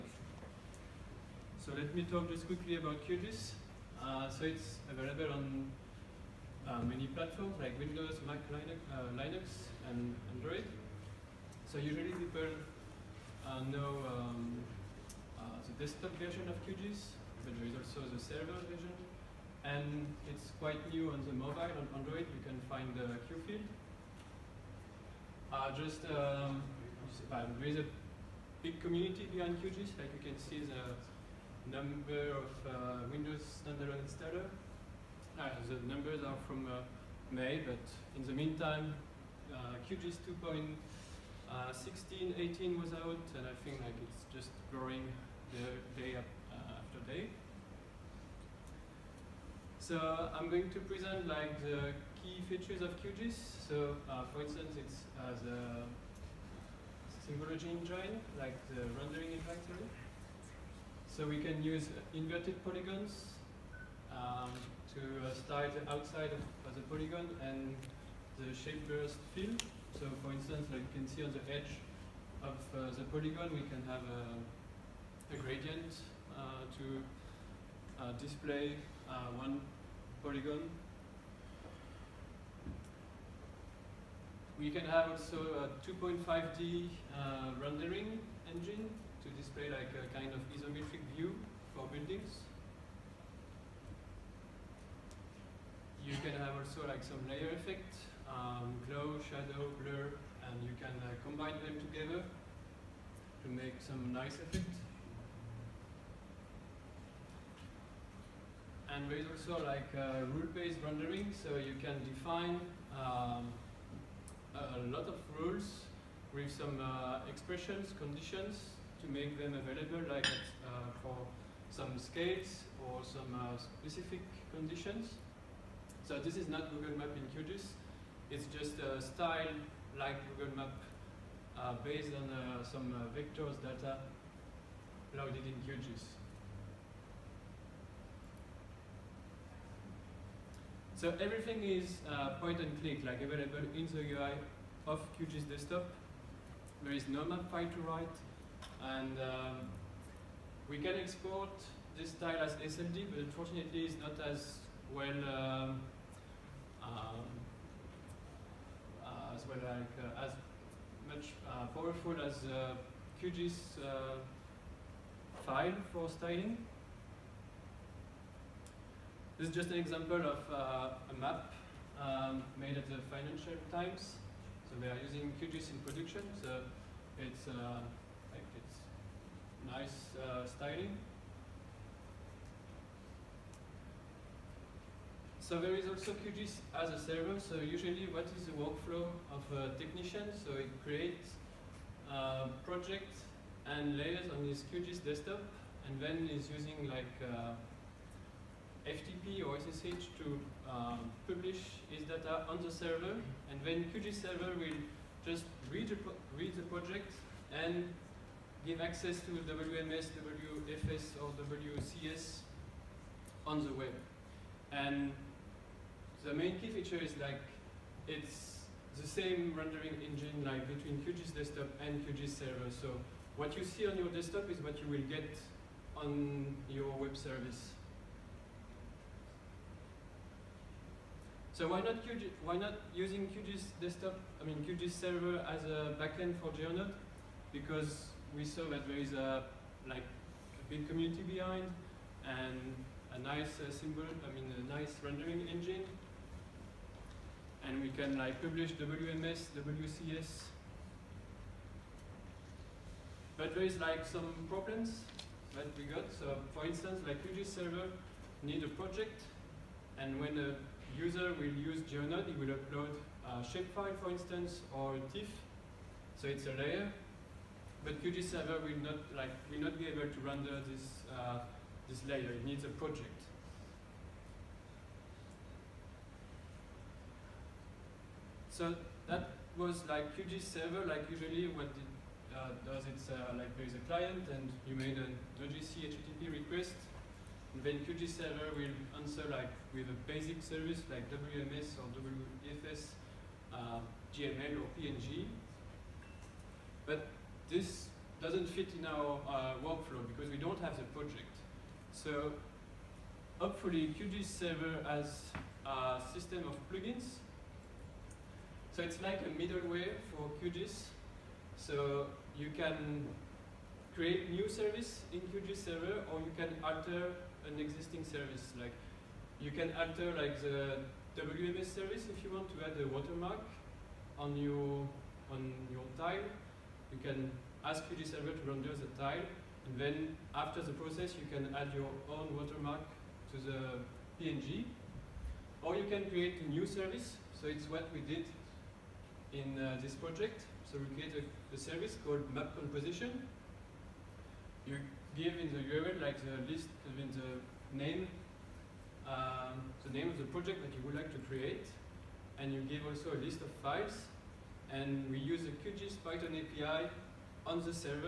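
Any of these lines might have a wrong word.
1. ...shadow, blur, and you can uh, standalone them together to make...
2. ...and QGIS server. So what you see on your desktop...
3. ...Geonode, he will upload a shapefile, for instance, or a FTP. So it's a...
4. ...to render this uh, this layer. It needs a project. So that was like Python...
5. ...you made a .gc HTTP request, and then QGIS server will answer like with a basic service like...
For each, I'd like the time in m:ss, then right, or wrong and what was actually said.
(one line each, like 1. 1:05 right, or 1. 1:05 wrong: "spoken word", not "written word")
1. 1:39 wrong: "combine", not "standalone"
2. 3:41 right
3. 4:21 wrong: "TIFF", not "FTP"
4. 4:30 wrong: "QGIS", not "Python"
5. 4:44 right.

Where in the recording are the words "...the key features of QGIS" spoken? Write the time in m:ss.
0:51.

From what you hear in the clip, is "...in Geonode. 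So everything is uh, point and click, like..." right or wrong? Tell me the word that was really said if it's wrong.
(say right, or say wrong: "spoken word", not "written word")
wrong: "QGIS", not "Geonode".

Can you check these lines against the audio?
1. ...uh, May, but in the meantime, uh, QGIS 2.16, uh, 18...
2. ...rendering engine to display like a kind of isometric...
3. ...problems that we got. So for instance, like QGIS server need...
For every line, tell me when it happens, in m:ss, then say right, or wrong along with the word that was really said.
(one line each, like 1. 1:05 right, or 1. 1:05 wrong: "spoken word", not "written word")
1. 0:36 right
2. 1:27 right
3. 4:14 right.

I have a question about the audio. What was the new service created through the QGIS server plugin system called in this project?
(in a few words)
map composition.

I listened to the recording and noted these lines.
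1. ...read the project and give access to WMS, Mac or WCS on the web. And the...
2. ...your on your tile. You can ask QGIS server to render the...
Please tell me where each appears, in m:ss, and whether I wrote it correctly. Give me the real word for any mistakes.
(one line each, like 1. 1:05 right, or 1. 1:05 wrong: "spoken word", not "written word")
1. 3:26 wrong: "WFS", not "Mac"
2. 5:24 right.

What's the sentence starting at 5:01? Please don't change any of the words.
So hopefully QGIS server has a system of plugins so it's like a middleware for QGIS.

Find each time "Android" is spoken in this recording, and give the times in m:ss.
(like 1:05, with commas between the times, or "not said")
0:10, 0:21.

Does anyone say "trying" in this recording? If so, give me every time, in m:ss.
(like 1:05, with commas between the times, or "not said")
not said.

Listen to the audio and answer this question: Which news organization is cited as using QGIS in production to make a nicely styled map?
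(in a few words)
Financial Times.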